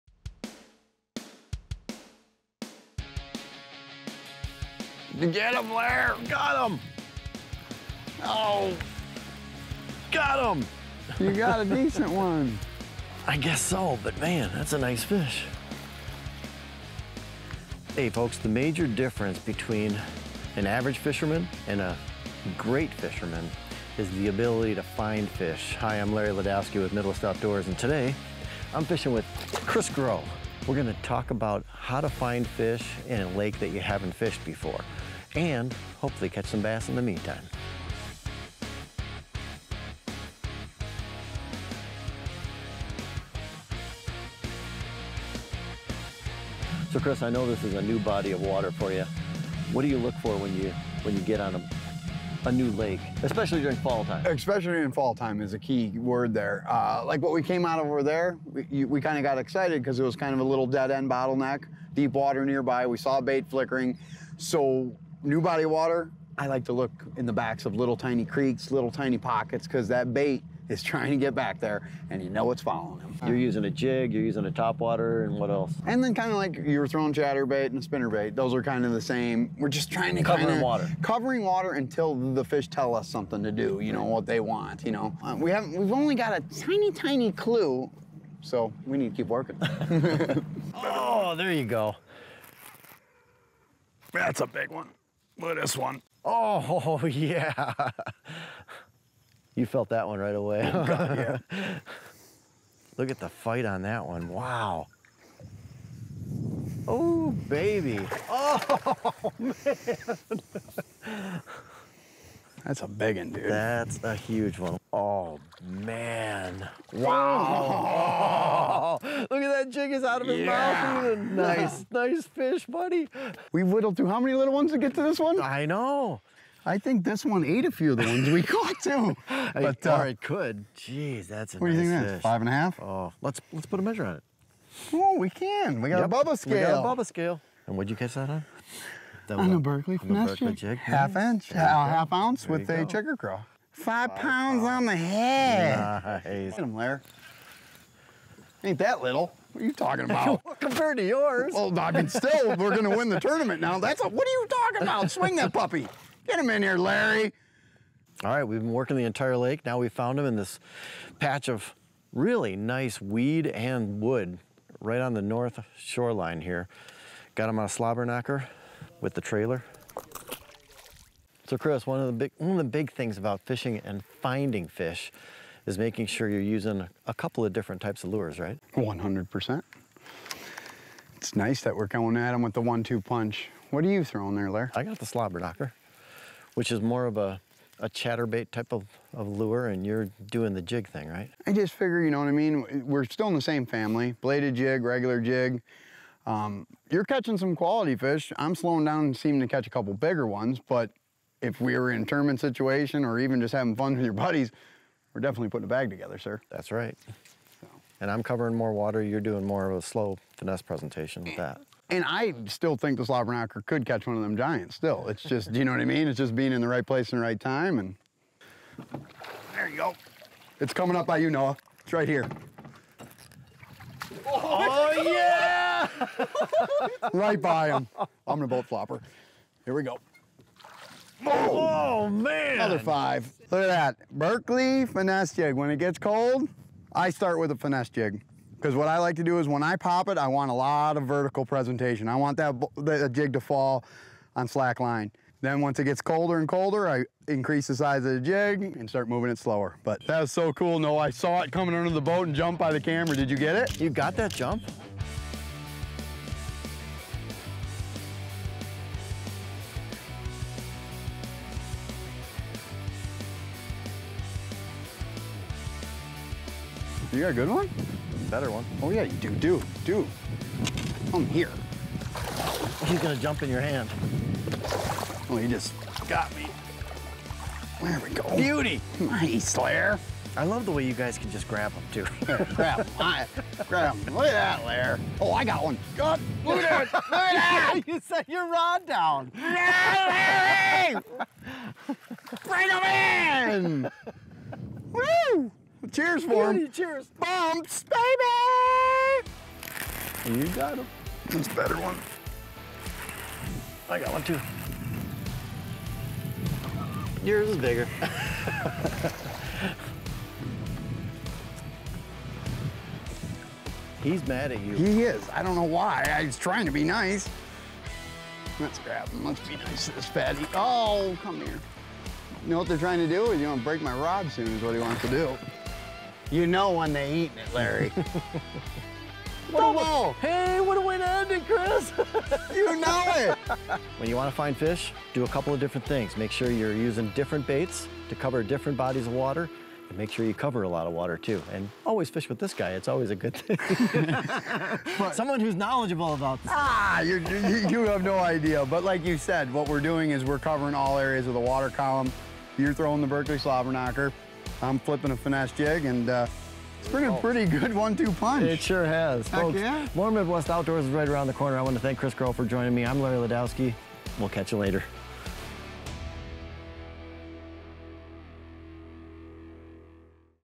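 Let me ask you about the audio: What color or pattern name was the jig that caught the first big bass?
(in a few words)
checker craw.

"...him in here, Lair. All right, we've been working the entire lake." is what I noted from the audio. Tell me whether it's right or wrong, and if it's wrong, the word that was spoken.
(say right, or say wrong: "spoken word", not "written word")
wrong: "Larry", not "Lair".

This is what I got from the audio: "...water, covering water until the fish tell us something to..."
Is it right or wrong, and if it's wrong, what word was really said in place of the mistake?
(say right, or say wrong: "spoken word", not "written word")
right.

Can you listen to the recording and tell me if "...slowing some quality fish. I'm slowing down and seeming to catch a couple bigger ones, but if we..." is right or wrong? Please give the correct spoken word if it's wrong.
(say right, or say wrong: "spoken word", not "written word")
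wrong: "catching", not "slowing".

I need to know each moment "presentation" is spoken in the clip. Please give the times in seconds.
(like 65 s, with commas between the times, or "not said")
210 s, 241 s.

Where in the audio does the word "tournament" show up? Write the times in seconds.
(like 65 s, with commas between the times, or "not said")
153 s, 202 s.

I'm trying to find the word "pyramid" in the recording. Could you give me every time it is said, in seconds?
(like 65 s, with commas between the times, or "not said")
not said.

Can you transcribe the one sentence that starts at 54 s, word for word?
Especially in fall time is a key word there.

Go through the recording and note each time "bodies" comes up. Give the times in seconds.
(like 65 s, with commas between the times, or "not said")
338 s.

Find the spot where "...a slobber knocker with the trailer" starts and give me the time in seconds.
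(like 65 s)
167 s.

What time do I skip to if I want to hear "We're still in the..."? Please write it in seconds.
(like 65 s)
192 s.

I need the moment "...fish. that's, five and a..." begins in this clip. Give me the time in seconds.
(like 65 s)
132 s.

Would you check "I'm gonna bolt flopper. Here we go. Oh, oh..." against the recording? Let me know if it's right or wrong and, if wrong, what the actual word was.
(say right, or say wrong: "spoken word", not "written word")
right.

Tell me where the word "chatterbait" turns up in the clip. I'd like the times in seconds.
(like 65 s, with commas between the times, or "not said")
77 s, 187 s.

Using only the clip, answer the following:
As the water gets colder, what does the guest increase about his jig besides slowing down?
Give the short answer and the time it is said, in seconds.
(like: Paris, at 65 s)
the size, at 247 s.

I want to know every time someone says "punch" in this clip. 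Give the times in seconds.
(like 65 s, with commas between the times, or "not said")
183 s, 358 s.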